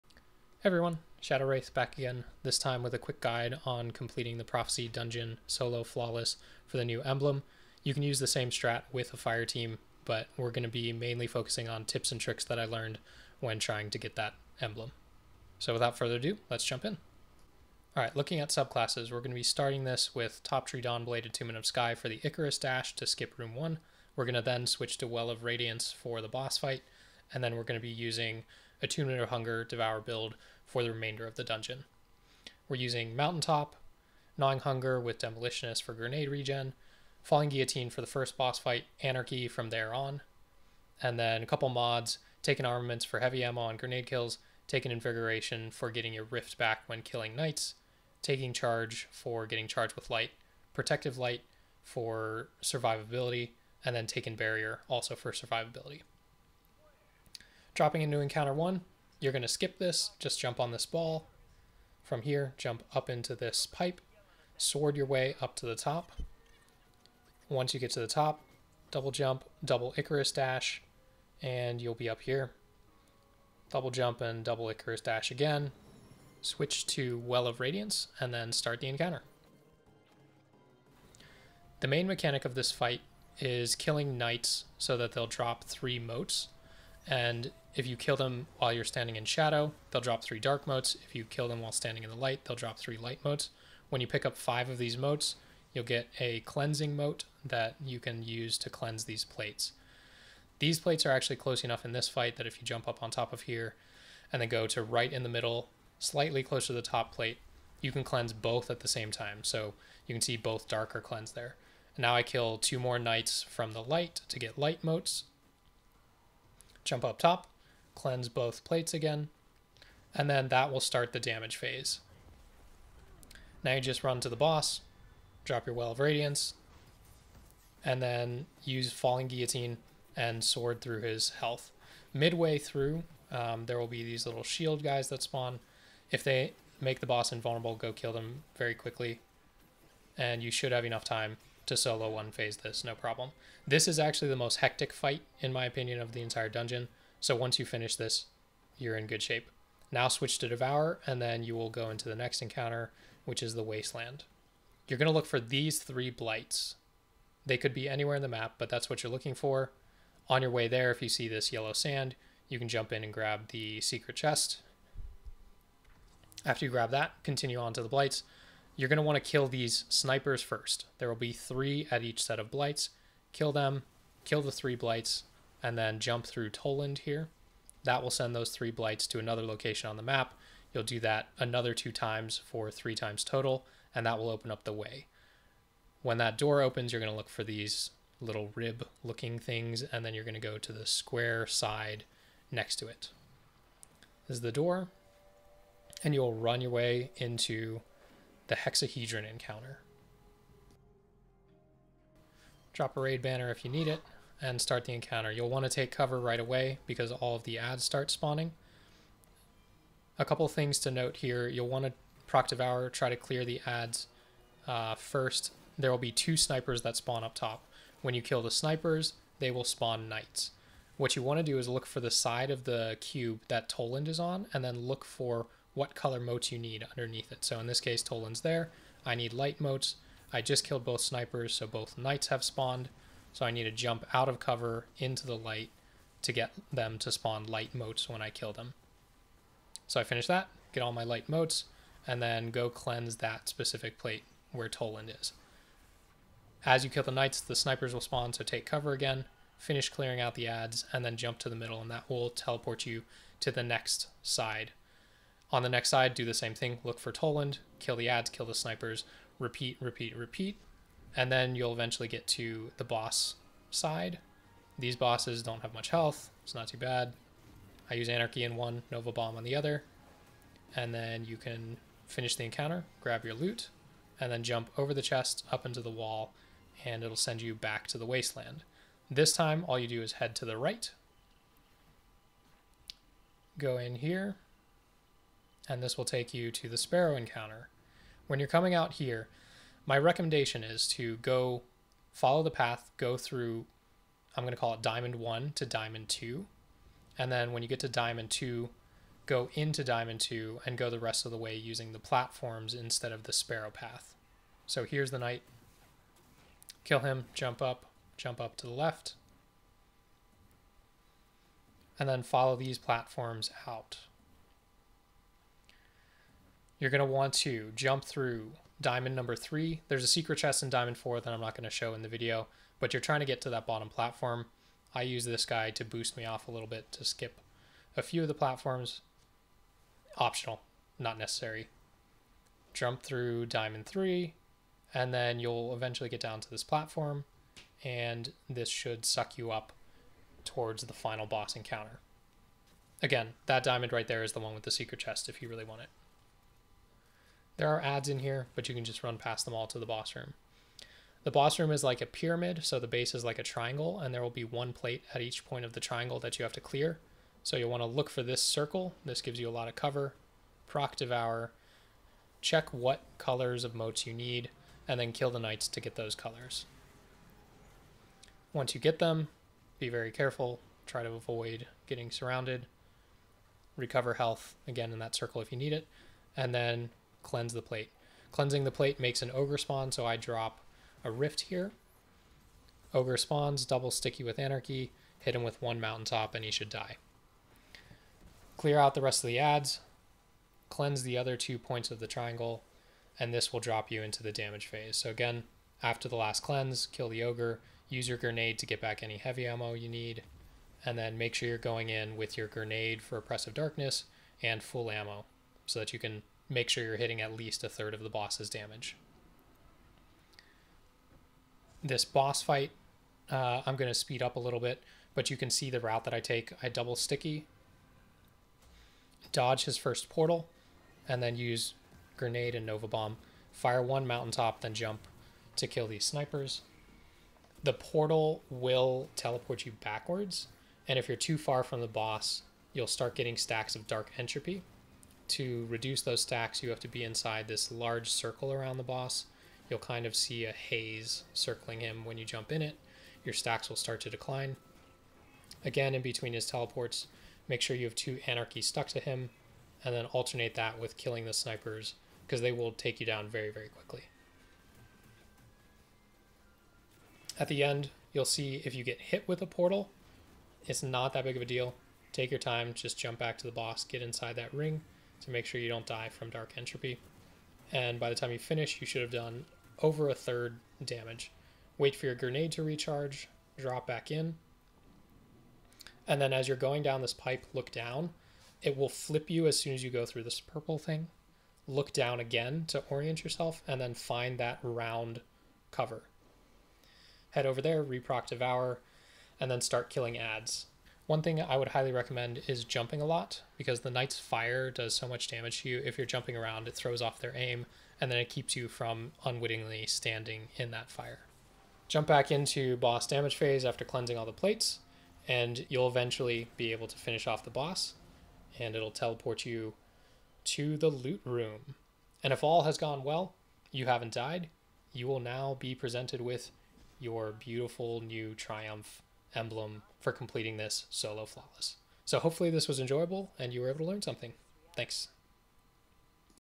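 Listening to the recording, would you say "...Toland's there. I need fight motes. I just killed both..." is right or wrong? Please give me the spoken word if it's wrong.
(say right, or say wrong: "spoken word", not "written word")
wrong: "light", not "fight".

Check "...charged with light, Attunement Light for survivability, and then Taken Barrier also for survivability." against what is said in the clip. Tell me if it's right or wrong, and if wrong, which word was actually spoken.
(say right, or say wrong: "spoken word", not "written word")
wrong: "Protective", not "Attunement".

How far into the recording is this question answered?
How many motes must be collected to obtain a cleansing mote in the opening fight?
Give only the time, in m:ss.
1:34.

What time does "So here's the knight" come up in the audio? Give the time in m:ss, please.
5:04.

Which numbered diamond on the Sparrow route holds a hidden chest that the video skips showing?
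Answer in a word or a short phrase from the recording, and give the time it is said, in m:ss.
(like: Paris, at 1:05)
Diamond 4, at 5:20.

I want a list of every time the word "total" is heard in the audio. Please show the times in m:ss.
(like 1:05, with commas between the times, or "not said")
3:03.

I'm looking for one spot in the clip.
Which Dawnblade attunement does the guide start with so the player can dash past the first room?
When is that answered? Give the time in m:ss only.
0:21.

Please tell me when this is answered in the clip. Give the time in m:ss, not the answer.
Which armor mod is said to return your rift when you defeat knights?
0:44.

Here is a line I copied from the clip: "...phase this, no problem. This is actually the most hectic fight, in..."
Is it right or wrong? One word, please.
right.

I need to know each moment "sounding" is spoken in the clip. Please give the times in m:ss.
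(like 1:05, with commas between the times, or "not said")
not said.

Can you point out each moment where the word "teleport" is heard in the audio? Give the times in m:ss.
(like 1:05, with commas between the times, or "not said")
4:12, 7:09, 7:26, 8:28.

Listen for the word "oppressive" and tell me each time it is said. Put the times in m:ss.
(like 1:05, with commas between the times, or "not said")
6:43.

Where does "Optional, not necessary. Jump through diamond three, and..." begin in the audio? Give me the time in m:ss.
5:30.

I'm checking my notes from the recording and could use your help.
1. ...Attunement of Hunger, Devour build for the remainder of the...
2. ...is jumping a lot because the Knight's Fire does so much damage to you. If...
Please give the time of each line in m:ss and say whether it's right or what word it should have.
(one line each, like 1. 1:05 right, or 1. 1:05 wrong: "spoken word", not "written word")
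1. 0:28 right
2. 8:12 right.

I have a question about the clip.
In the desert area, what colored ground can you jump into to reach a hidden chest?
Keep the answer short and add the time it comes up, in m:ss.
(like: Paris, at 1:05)
yellow sand, at 2:41.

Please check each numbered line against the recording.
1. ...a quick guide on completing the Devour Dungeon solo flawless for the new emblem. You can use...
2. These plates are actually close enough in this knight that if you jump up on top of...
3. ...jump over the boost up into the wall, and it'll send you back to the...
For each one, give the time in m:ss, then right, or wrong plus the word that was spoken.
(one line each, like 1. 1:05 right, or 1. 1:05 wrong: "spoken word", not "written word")
1. 0:02 wrong: "Prophecy", not "Devour"
2. 1:40 wrong: "fight", not "knight"
3. 4:34 wrong: "chest", not "boost".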